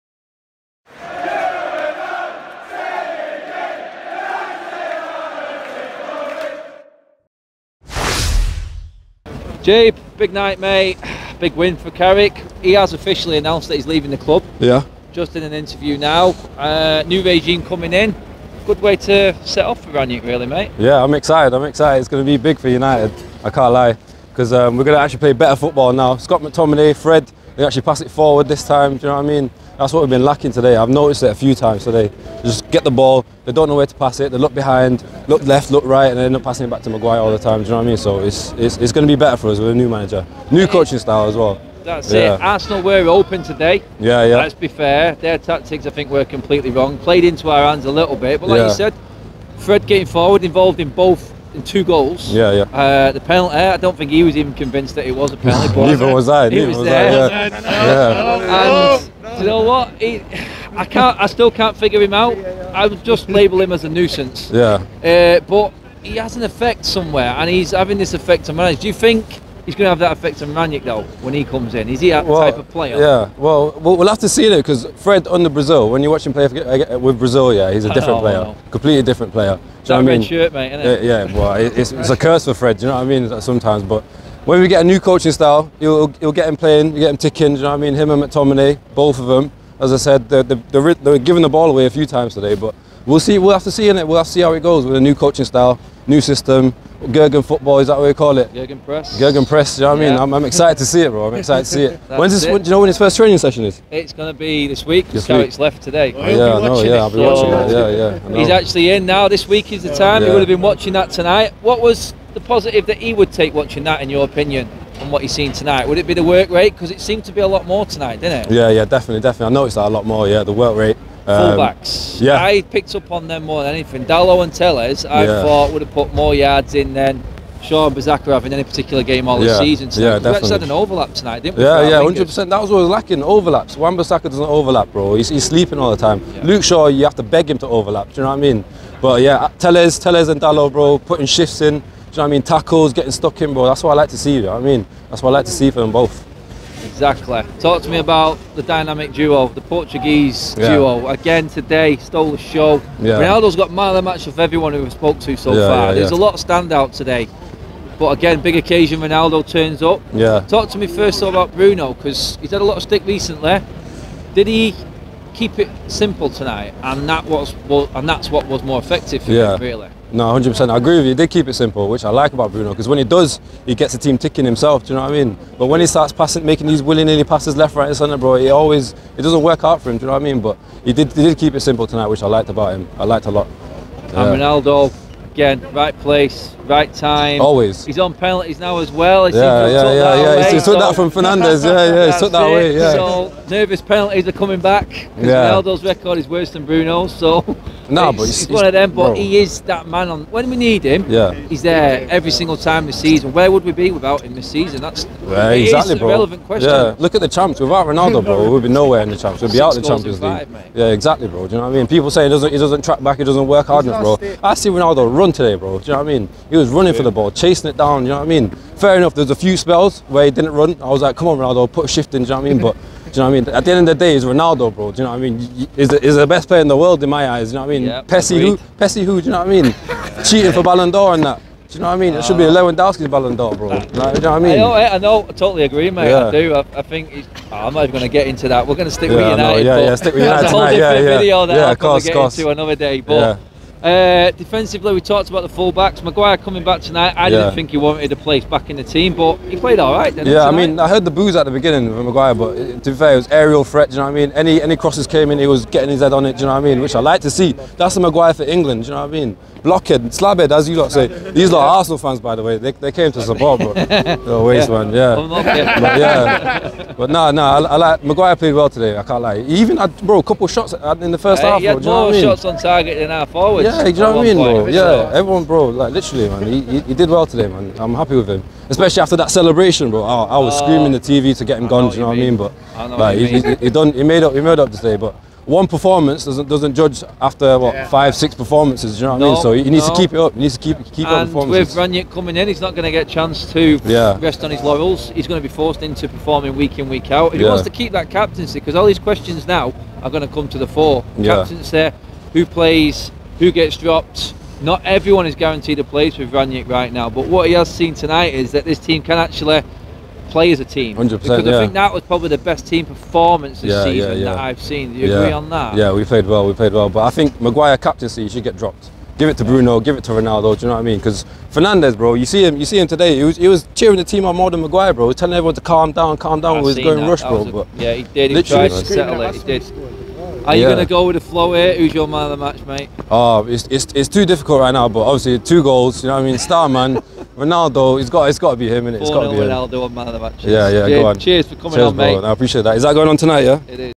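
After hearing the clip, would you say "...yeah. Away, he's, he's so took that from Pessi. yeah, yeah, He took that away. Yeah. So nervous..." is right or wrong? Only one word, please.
wrong.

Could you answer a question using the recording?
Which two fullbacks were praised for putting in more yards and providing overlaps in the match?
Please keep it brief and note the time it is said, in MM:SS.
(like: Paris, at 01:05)
Dalot and Telles, at 02:04.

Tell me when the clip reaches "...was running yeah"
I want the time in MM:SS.
03:36.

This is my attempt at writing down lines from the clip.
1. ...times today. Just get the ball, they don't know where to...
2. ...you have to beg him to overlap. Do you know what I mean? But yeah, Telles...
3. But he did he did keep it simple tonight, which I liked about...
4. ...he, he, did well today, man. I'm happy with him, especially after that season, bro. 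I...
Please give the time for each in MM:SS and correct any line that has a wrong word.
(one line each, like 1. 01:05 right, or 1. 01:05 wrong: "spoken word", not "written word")
1. 00:31 right
2. 02:16 right
3. 03:00 right
4. 04:36 wrong: "celebration", not "season".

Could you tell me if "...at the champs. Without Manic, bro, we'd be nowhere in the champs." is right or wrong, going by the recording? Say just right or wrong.
wrong.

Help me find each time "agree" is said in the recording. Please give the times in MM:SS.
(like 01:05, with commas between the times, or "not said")
02:50, 03:55, 05:15.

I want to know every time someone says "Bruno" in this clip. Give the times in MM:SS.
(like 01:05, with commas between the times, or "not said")
02:41, 02:52, 03:16, 05:19.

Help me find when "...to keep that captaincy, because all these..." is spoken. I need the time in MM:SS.
04:57.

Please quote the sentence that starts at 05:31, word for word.
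Who's your man of the match, mate?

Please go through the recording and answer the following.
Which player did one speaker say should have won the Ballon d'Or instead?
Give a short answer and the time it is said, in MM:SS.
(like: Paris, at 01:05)
Lewandowski, at 03:52.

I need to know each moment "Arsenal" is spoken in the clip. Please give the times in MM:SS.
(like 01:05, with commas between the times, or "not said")
00:42, 04:21.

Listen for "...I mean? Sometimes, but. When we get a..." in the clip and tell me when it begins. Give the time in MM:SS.
01:23.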